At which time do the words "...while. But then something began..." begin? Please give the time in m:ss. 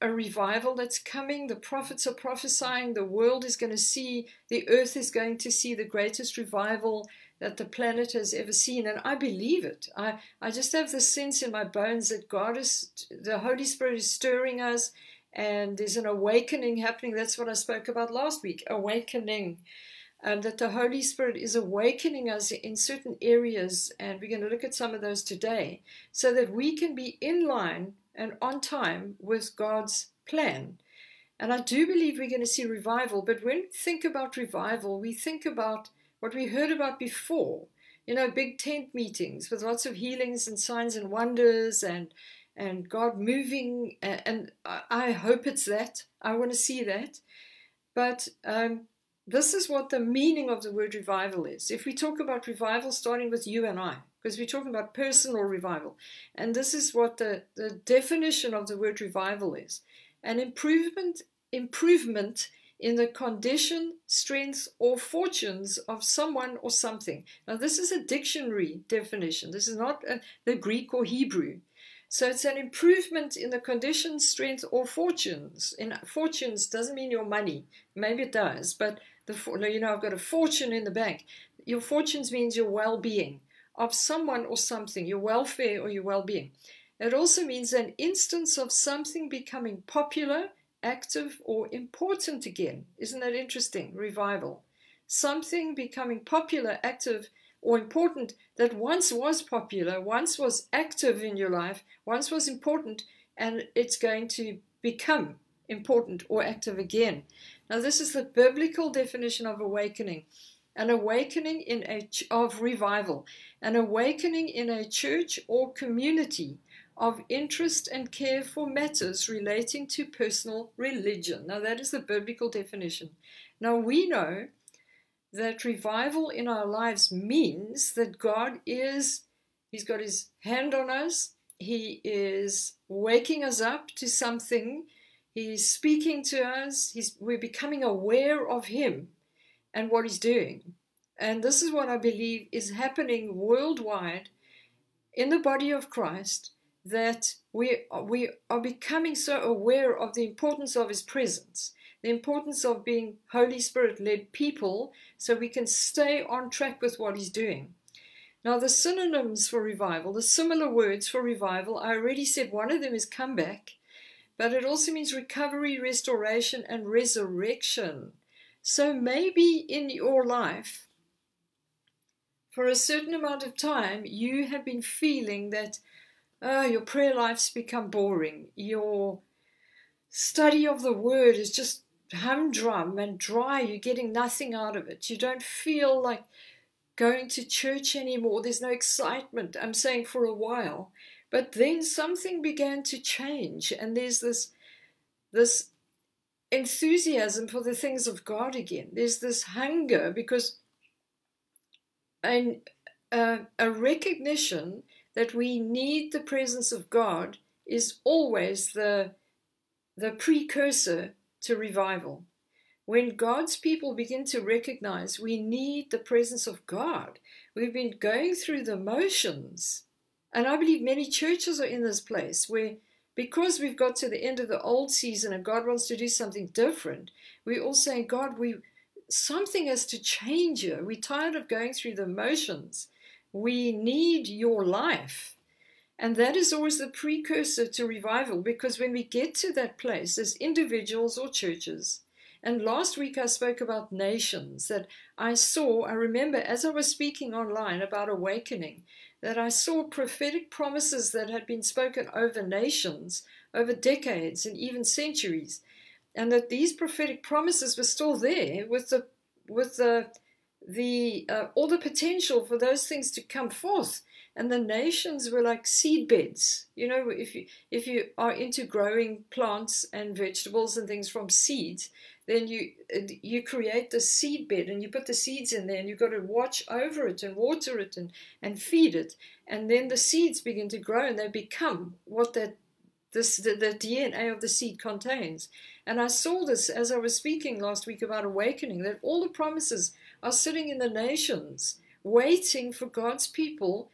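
3:10.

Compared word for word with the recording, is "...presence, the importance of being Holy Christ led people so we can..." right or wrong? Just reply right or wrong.
wrong.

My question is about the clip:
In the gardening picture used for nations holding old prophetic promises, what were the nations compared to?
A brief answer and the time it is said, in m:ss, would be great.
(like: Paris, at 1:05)
seed beds, at 4:25.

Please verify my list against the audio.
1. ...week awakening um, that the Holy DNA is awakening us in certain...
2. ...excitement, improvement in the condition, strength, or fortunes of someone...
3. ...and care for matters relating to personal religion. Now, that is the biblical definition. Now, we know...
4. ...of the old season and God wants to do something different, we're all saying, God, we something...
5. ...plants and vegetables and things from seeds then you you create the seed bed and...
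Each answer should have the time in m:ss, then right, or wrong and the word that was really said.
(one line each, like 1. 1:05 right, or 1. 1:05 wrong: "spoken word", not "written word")
1. 0:18 wrong: "Spirit", not "DNA"
2. 1:00 wrong: "improvement", not "excitement"
3. 1:57 right
4. 3:44 right
5. 4:29 right.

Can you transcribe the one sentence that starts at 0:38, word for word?
You know, big tent meetings with lots of healings and signs and wonders and and God moving.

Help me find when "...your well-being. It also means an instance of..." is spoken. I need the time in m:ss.
1:25.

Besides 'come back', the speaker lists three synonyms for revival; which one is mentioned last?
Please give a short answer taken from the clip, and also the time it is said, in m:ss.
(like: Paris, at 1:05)
resurrection, at 2:46.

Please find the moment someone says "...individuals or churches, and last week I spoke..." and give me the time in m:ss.
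4:00.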